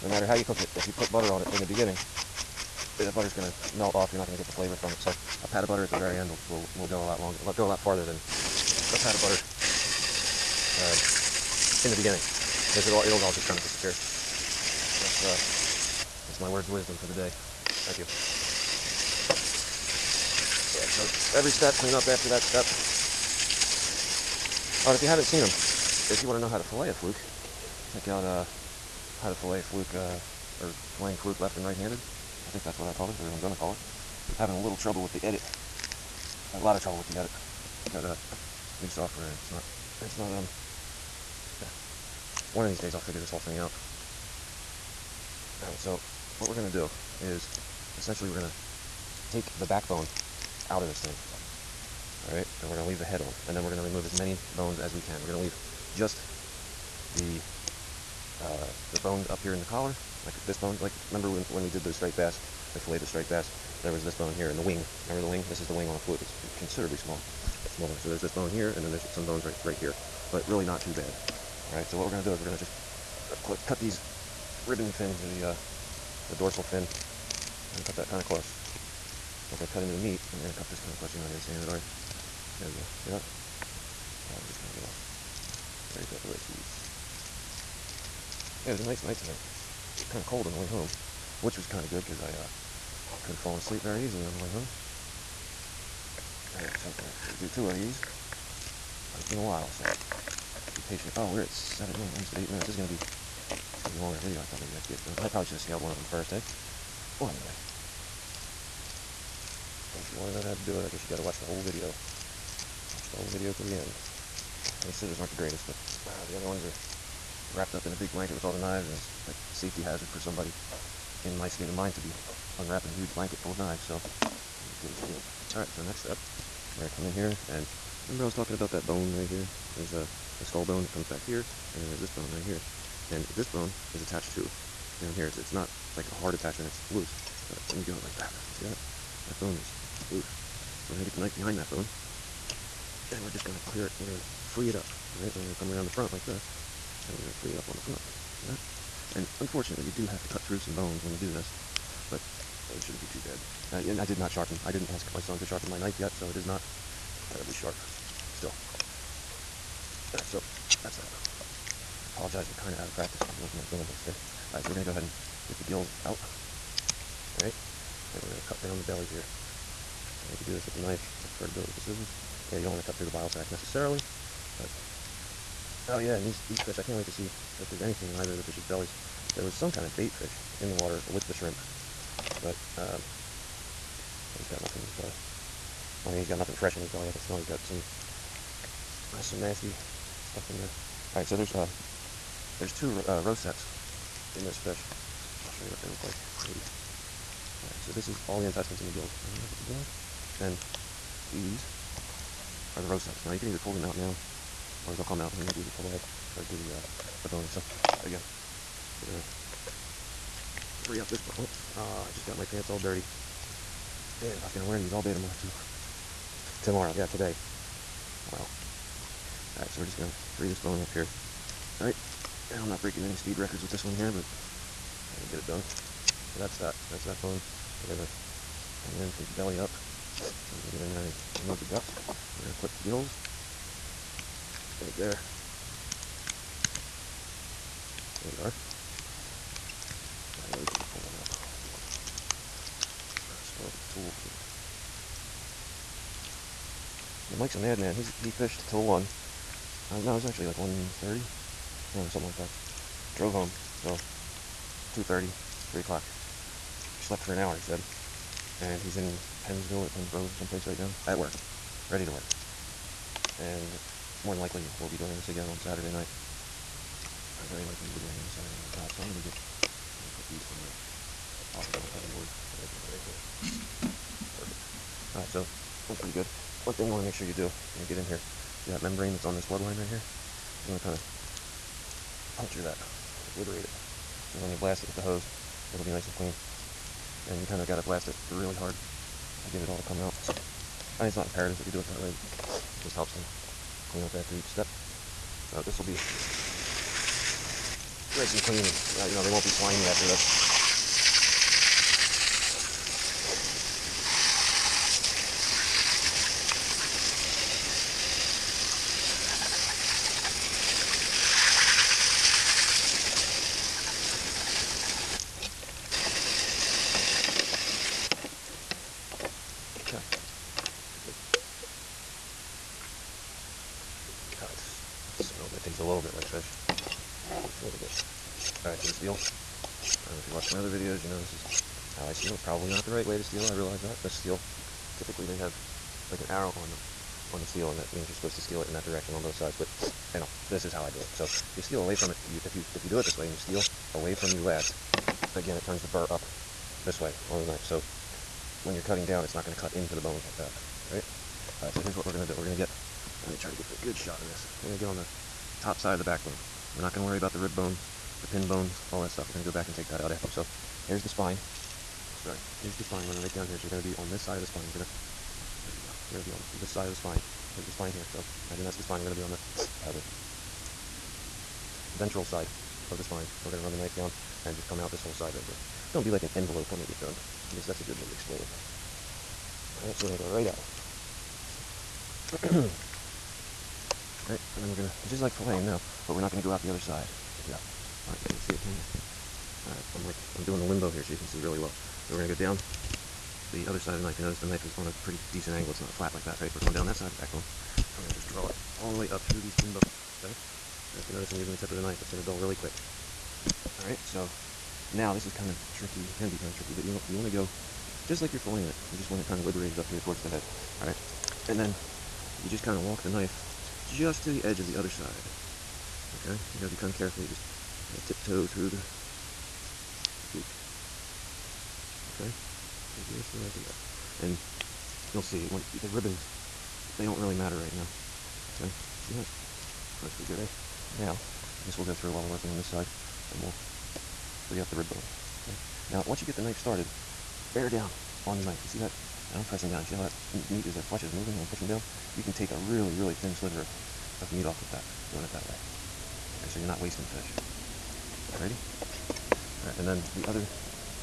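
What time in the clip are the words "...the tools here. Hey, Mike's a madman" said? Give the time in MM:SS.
04:03.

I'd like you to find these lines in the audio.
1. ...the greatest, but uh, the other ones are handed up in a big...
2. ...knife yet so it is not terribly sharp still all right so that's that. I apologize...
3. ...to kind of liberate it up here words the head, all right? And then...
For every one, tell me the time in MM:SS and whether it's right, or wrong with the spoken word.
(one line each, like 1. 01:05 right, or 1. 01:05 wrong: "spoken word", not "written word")
1. 01:55 wrong: "wrapped", not "handed"
2. 02:35 right
3. 06:49 wrong: "towards", not "words".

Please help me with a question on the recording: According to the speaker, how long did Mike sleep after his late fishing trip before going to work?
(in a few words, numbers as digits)
an hour.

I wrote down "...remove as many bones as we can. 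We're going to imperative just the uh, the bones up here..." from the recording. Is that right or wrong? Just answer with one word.
wrong.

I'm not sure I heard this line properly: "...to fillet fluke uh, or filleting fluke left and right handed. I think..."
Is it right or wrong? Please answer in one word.
right.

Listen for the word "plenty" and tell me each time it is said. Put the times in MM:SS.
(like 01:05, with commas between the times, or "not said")
not said.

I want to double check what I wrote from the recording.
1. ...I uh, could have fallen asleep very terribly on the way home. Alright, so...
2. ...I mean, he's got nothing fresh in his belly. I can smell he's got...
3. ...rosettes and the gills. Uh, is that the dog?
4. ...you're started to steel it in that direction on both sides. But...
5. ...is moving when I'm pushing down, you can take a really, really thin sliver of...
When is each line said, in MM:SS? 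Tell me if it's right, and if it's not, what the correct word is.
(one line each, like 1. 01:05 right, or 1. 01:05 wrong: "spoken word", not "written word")
1. 01:32 wrong: "easily", not "terribly"
2. 03:06 right
3. 03:18 wrong: "intestines", not "rosettes"
4. 05:38 wrong: "supposed", not "started"
5. 07:21 right.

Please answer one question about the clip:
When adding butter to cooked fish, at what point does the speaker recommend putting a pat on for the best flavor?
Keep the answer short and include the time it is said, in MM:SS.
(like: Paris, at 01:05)
at the very end, at 00:05.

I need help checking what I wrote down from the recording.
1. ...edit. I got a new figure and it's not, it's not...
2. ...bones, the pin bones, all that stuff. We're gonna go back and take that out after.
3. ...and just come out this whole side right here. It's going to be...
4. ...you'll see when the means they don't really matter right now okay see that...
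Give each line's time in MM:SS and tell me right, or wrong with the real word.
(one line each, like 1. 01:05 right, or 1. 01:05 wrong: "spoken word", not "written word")
1. 00:37 wrong: "software", not "figure"
2. 05:57 right
3. 06:14 right
4. 07:05 wrong: "ribbons", not "means".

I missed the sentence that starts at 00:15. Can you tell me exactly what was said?
Uh, my words of wisdom for the day.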